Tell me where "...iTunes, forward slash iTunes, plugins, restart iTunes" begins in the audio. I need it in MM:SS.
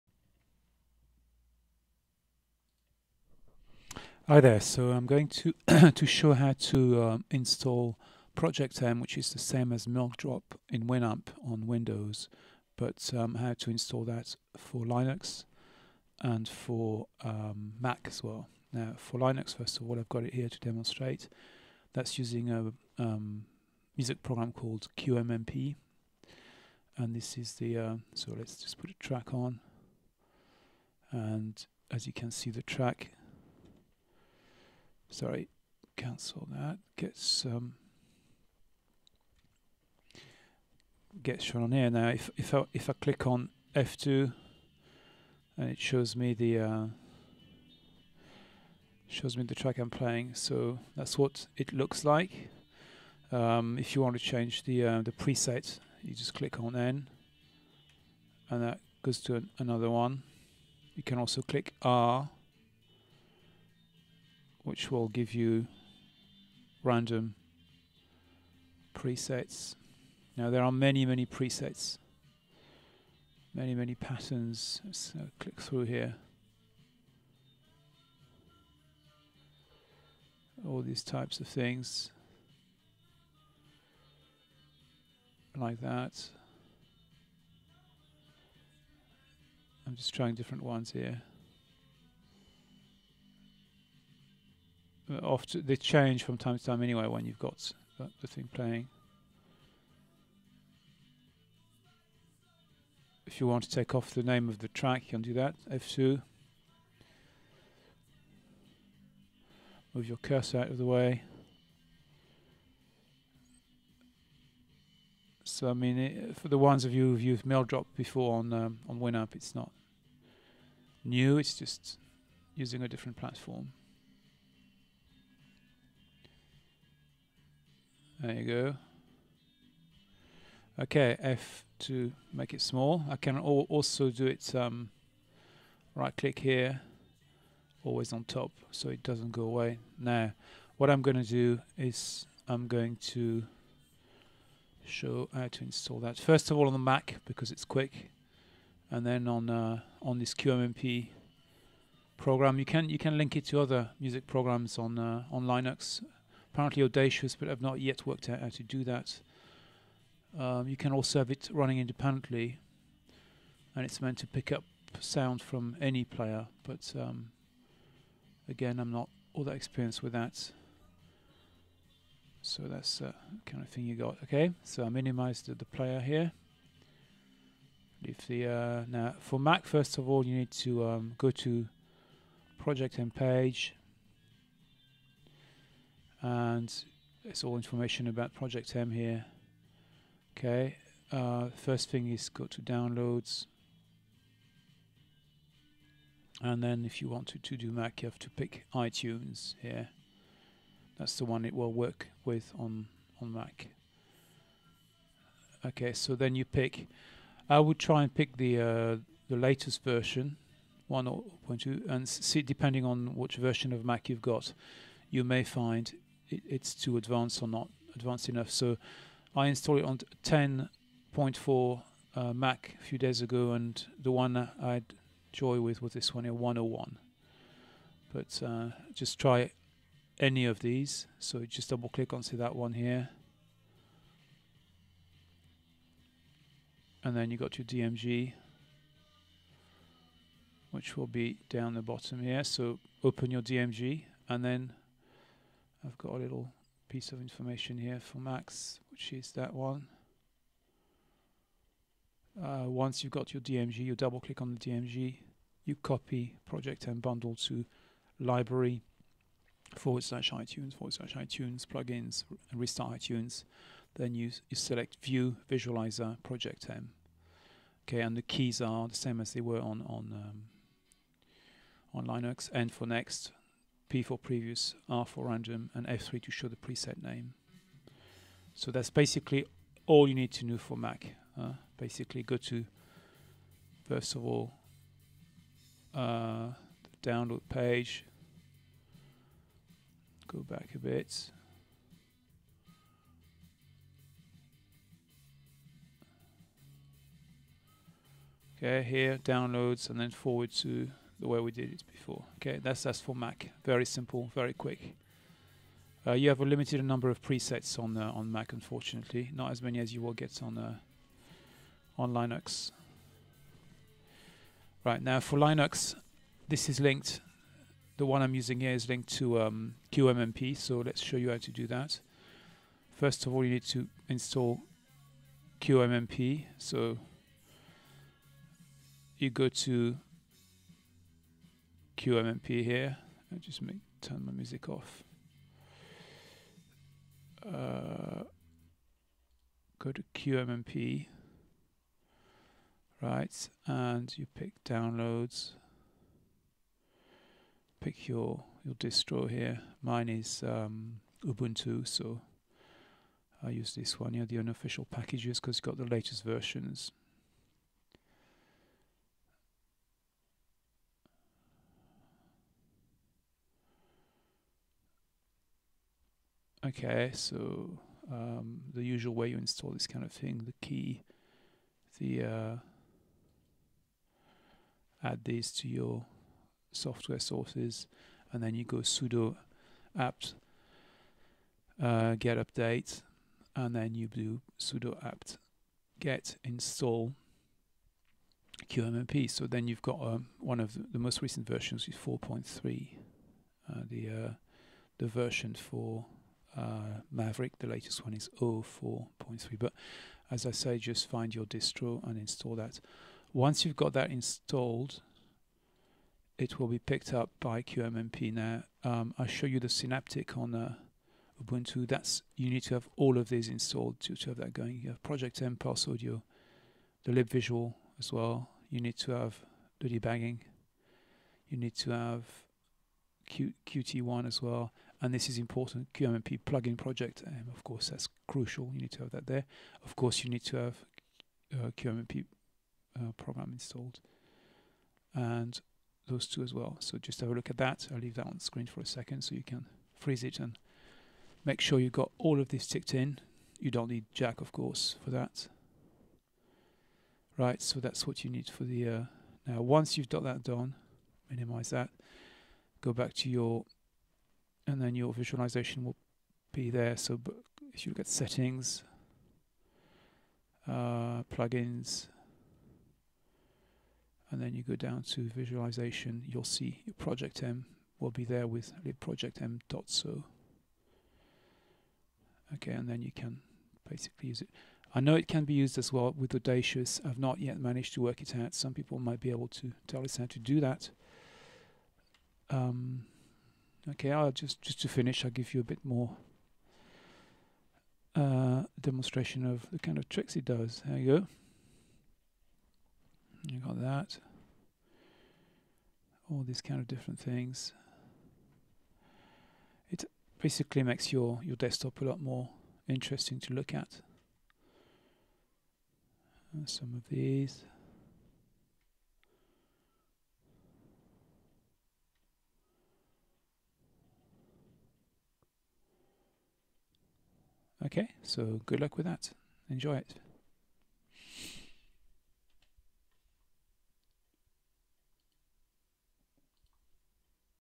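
04:20.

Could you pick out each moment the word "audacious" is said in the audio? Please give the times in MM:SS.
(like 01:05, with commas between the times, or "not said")
02:36, 07:56.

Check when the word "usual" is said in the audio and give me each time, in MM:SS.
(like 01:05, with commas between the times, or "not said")
06:08.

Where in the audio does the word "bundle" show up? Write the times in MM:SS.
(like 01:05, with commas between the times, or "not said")
04:16.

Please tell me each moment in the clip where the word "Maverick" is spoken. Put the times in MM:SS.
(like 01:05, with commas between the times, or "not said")
06:37.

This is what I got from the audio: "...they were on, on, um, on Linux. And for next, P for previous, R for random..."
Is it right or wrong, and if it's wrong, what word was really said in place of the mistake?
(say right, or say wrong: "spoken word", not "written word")
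right.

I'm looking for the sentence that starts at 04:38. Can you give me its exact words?
So that's basically all you need to know for Mac.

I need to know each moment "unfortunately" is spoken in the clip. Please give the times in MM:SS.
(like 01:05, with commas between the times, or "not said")
05:08.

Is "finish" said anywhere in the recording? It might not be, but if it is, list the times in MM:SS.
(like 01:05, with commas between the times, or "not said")
08:04.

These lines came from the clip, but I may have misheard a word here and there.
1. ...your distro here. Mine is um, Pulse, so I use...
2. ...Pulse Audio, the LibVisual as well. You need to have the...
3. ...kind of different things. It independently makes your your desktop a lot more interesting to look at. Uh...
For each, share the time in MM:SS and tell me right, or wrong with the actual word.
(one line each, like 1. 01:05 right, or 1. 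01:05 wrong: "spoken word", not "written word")
1. 05:48 wrong: "Ubuntu", not "Pulse"
2. 06:55 right
3. 08:16 wrong: "basically", not "independently".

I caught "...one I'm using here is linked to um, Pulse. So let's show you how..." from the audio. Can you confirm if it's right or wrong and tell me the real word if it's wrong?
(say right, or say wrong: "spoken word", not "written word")
wrong: "QMMP", not "Pulse".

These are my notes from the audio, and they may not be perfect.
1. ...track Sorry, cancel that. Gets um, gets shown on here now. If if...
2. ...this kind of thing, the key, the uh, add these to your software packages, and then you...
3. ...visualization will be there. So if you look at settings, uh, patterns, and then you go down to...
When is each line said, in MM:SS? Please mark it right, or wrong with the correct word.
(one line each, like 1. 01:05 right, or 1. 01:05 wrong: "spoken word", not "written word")
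1. 00:32 right
2. 06:09 wrong: "sources", not "packages"
3. 07:35 wrong: "plugins", not "patterns".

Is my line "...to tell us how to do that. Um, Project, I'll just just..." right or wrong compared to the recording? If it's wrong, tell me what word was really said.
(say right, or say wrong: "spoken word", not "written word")
wrong: "Okay", not "Project".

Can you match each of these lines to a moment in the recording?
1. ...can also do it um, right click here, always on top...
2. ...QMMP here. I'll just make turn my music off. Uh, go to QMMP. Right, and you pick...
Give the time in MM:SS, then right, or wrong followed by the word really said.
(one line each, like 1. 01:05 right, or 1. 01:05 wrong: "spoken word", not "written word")
1. 02:13 right
2. 05:32 right.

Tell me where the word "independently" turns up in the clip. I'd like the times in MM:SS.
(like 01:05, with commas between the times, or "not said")
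02:41.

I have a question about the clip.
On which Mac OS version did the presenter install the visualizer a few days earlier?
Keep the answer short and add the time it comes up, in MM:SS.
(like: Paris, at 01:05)
10.4, at 03:40.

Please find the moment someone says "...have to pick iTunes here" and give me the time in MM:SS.
03:18.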